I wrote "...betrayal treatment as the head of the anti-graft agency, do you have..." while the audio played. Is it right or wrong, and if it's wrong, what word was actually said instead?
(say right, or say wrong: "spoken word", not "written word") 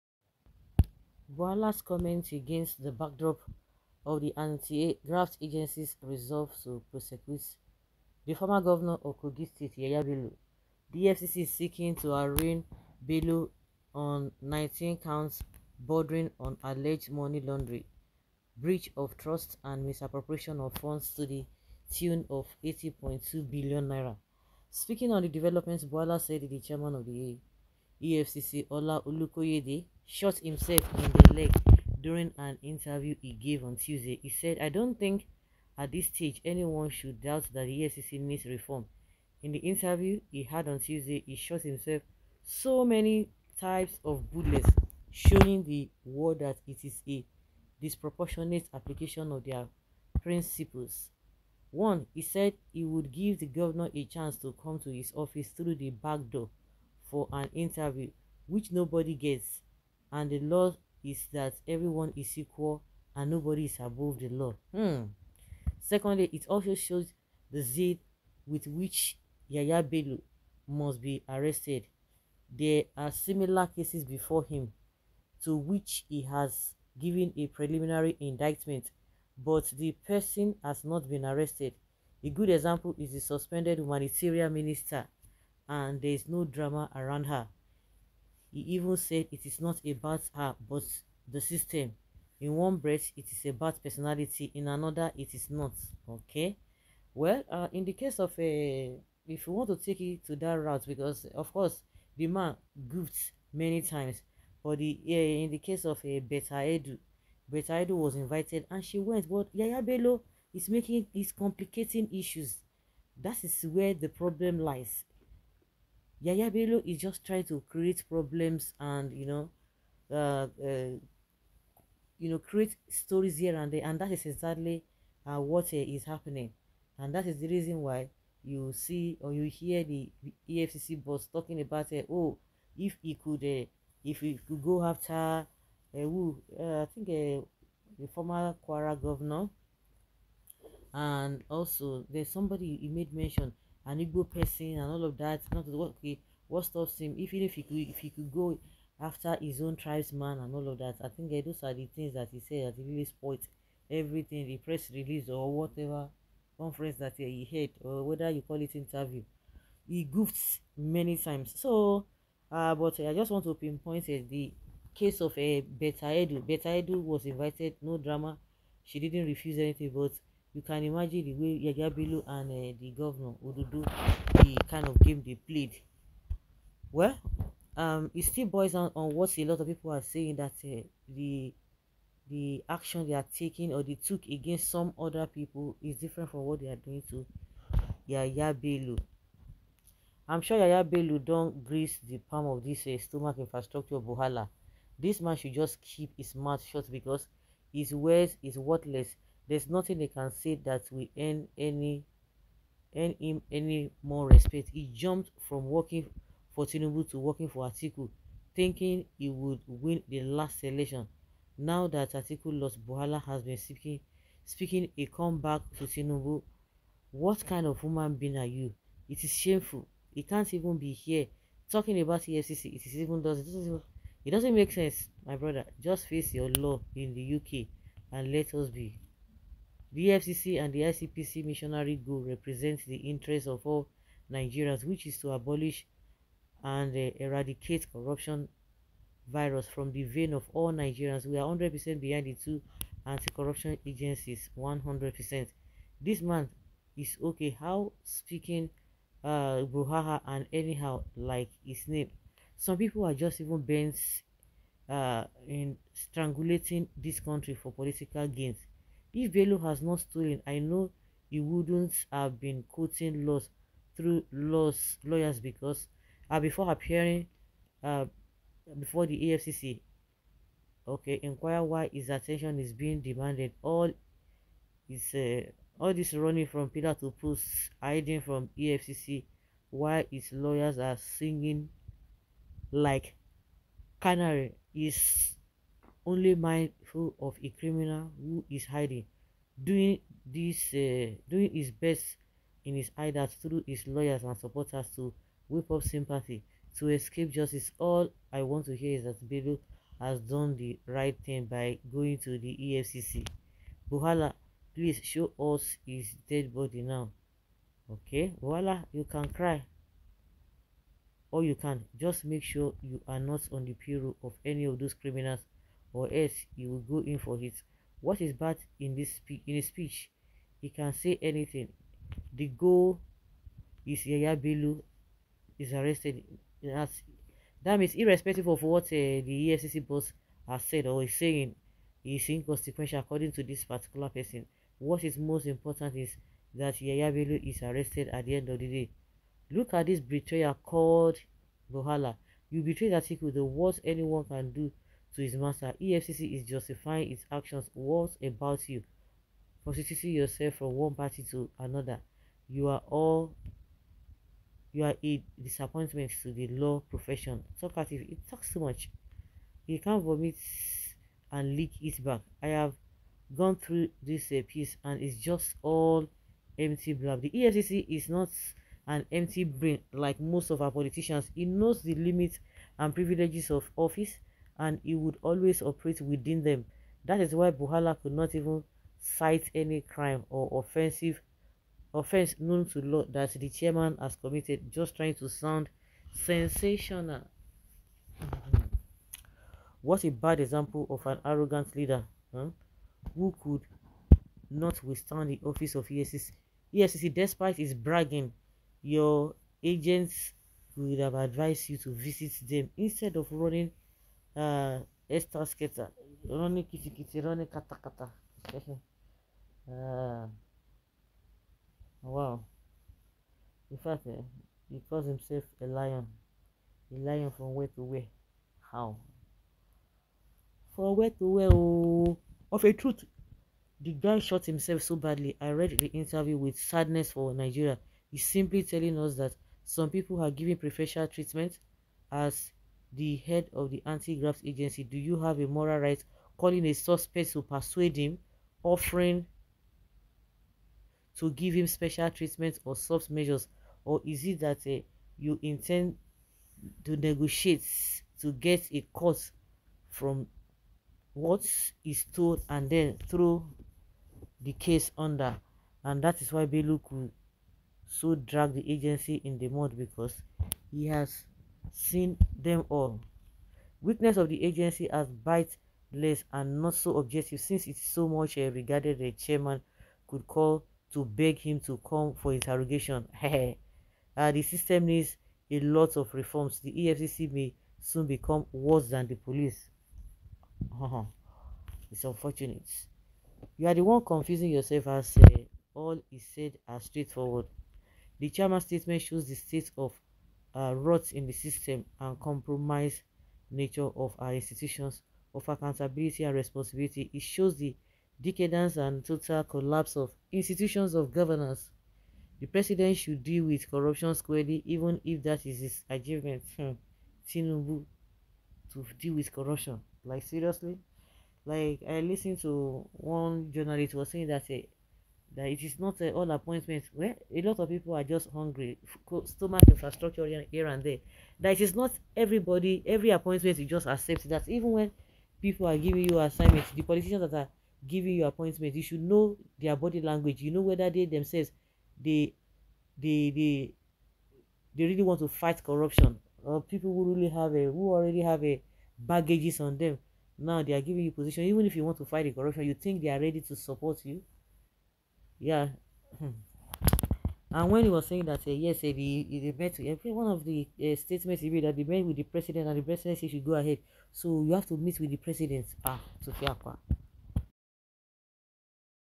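wrong: "preferential", not "betrayal".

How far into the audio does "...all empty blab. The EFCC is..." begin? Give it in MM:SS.
06:05.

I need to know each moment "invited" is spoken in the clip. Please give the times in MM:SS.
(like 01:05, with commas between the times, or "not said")
01:48, 02:47.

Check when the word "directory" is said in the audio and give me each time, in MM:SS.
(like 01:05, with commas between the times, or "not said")
not said.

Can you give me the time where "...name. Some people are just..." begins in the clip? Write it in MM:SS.
04:11.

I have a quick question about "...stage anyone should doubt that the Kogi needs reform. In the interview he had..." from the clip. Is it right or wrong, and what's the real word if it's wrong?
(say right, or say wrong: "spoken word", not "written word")
wrong: "EFCC", not "Kogi".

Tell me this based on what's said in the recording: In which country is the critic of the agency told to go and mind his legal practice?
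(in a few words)
UK.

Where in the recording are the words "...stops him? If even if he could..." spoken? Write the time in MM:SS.
02:26.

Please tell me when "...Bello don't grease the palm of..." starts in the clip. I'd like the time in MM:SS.
03:10.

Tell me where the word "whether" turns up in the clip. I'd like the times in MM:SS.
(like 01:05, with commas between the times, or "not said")
02:38, 08:50.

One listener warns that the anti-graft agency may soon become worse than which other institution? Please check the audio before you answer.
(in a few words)
the police.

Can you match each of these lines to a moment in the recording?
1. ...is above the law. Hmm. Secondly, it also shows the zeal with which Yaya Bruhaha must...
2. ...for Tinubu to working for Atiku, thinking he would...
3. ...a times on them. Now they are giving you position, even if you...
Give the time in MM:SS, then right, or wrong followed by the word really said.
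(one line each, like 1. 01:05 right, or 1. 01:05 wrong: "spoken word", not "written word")
1. 01:03 wrong: "Bello", not "Bruhaha"
2. 03:26 right
3. 08:58 wrong: "baggages", not "times".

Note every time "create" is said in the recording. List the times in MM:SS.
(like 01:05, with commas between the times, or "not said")
01:57, 02:02.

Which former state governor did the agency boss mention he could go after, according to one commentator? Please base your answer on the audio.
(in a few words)
Kwara governor.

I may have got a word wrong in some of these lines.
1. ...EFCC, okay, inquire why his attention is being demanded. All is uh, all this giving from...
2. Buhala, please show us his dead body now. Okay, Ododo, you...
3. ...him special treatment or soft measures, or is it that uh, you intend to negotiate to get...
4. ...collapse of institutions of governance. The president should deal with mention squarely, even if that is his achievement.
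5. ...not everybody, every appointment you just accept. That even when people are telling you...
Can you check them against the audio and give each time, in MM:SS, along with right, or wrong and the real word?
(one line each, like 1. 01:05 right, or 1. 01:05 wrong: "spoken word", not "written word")
1. 04:29 wrong: "running", not "giving"
2. 05:03 wrong: "Buhala", not "Ododo"
3. 07:21 right
4. 08:19 wrong: "corruption", not "mention"
5. 08:41 wrong: "giving", not "telling".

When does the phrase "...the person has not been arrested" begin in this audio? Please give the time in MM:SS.
01:19.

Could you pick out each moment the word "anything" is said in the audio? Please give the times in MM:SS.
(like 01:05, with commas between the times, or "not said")
02:49, 05:21.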